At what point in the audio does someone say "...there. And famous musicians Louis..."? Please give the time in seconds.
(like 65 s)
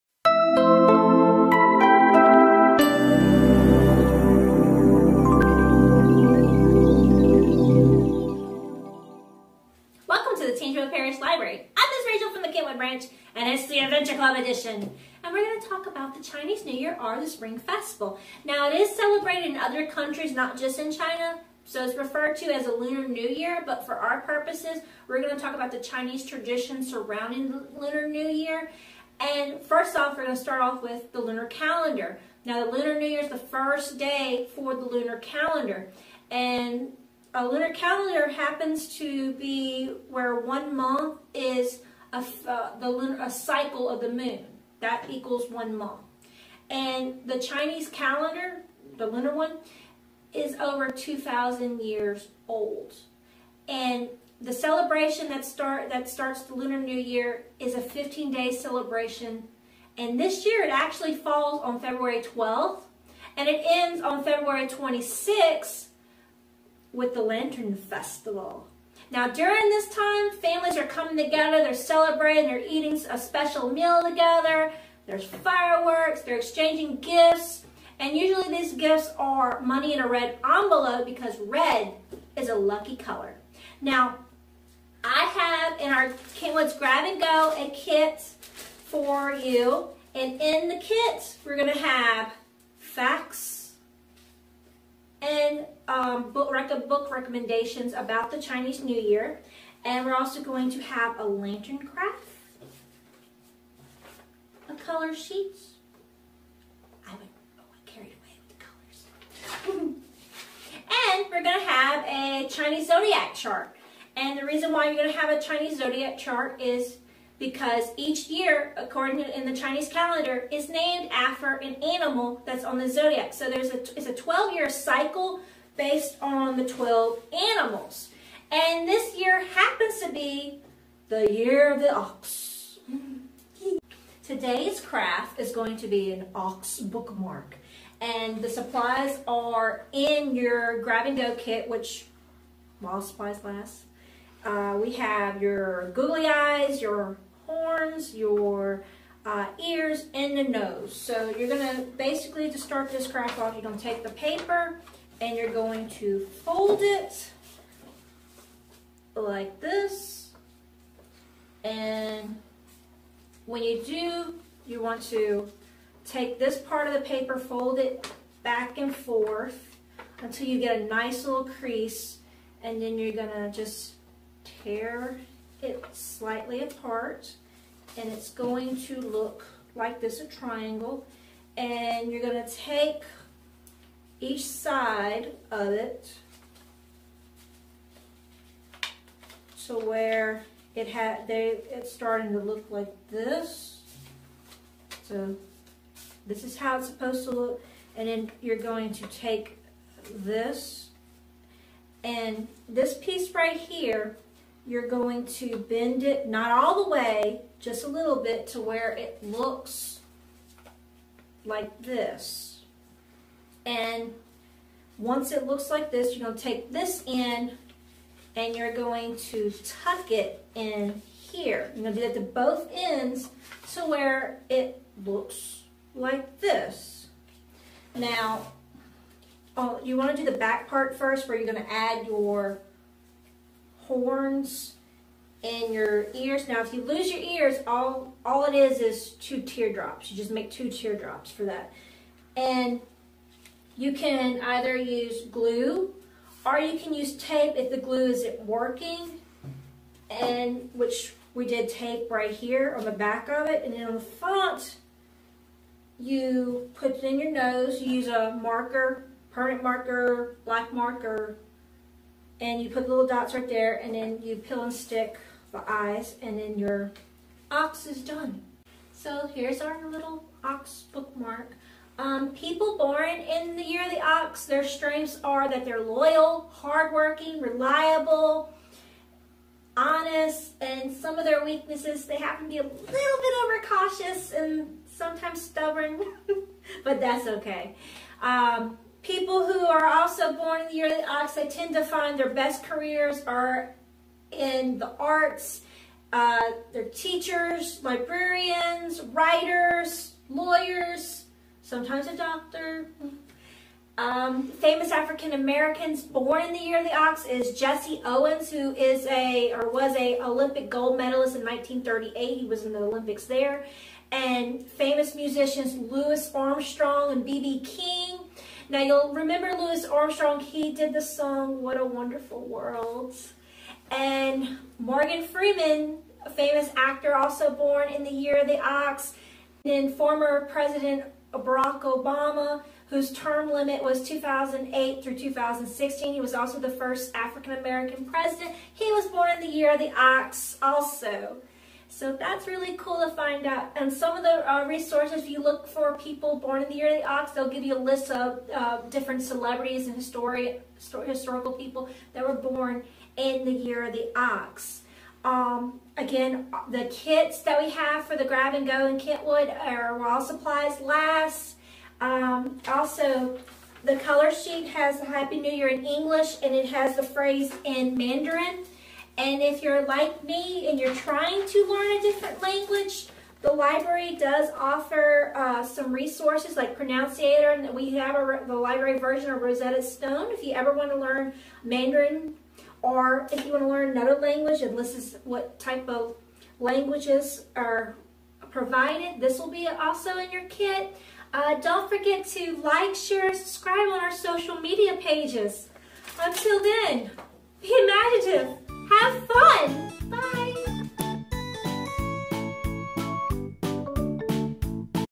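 313 s.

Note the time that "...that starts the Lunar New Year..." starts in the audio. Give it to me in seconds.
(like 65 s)
55 s.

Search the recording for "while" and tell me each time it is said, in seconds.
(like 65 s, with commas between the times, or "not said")
142 s, 359 s.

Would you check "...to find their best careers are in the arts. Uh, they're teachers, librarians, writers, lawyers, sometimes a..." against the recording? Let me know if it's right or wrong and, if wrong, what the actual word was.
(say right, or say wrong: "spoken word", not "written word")
right.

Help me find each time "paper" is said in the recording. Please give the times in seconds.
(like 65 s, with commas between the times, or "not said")
154 s, 167 s.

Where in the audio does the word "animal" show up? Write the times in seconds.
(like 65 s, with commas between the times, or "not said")
121 s, 127 s.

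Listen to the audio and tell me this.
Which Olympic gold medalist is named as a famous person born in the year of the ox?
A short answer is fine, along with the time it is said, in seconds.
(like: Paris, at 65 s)
Jesse Owens, at 307 s.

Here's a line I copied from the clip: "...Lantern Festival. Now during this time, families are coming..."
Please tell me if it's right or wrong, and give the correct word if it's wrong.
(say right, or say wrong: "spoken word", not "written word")
right.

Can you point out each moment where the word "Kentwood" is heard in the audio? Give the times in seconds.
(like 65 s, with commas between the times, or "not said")
86 s, 358 s.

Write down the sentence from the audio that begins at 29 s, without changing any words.
And first off, we're going to start off with the lunar calendar.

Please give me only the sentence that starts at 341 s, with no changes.
So that's really cool to find out.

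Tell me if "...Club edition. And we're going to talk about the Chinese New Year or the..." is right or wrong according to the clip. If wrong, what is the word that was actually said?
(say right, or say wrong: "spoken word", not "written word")
right.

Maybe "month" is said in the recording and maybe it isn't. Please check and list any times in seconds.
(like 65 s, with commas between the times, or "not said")
40 s, 45 s.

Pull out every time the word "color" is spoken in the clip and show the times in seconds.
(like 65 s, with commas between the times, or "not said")
82 s, 104 s, 109 s, 363 s.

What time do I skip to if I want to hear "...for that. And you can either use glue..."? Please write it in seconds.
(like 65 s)
241 s.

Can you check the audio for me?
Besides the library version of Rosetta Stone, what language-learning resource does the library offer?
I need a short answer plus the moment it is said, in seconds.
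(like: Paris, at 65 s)
Pronunciator, at 376 s.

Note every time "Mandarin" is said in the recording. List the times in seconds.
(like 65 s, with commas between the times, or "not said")
367 s, 381 s.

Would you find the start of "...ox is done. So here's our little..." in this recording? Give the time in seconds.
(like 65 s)
267 s.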